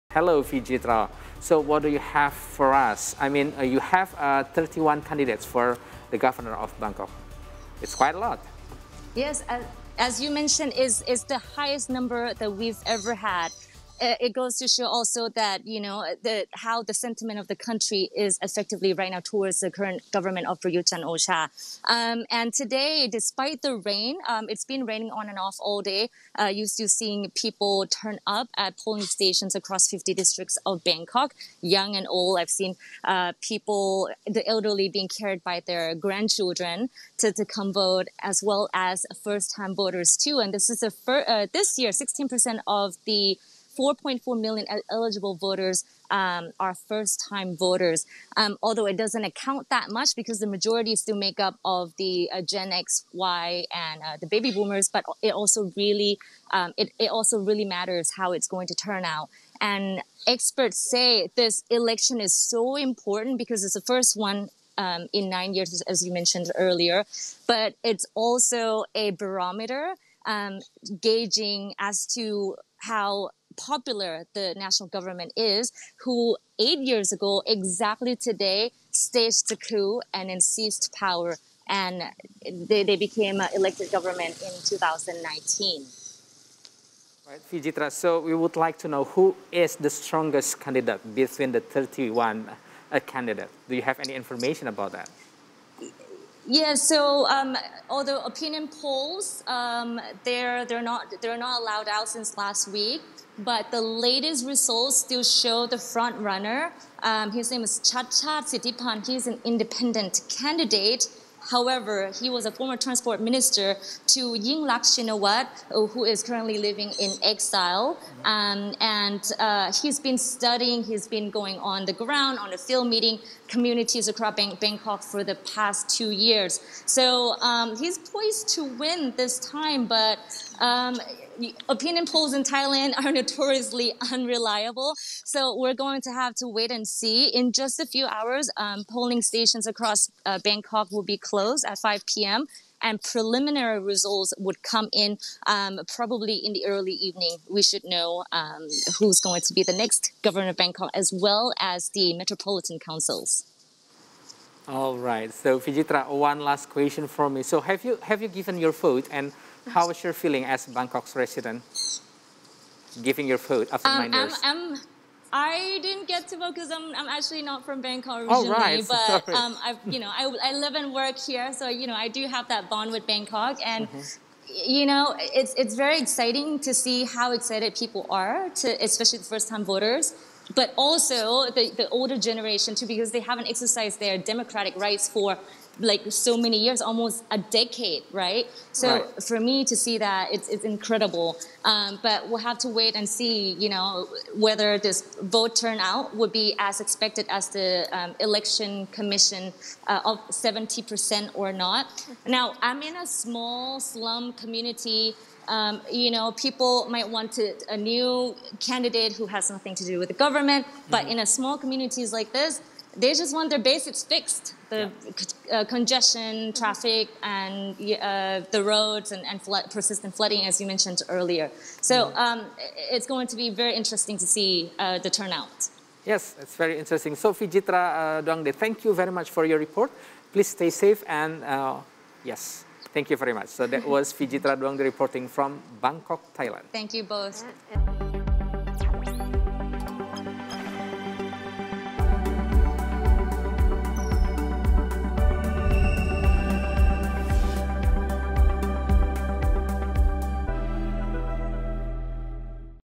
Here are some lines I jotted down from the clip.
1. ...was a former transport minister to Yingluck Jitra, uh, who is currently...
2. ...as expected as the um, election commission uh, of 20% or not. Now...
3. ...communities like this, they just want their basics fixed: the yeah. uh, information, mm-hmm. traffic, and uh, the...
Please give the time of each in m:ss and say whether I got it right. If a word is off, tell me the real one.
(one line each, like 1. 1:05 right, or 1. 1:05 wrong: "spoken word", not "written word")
1. 1:52 wrong: "Shinawat", not "Jitra"
2. 3:16 wrong: "70", not "20"
3. 3:31 wrong: "congestion", not "information".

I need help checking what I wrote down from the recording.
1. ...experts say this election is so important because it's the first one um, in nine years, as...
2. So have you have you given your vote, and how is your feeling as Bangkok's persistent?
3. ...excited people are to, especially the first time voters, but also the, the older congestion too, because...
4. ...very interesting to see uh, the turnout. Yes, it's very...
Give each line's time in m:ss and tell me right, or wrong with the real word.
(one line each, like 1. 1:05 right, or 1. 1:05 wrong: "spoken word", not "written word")
1. 1:00 right
2. 2:37 wrong: "resident", not "persistent"
3. 2:57 wrong: "generation", not "congestion"
4. 3:43 right.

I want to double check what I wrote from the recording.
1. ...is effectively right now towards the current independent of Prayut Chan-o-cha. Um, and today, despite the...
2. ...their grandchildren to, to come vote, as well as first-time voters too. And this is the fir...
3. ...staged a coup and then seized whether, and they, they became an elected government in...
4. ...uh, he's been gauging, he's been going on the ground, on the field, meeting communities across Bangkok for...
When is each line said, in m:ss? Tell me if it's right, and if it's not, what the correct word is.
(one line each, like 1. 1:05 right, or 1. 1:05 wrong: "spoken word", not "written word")
1. 0:18 wrong: "government", not "independent"
2. 0:35 right
3. 1:18 wrong: "power", not "whether"
4. 1:59 wrong: "studying", not "gauging".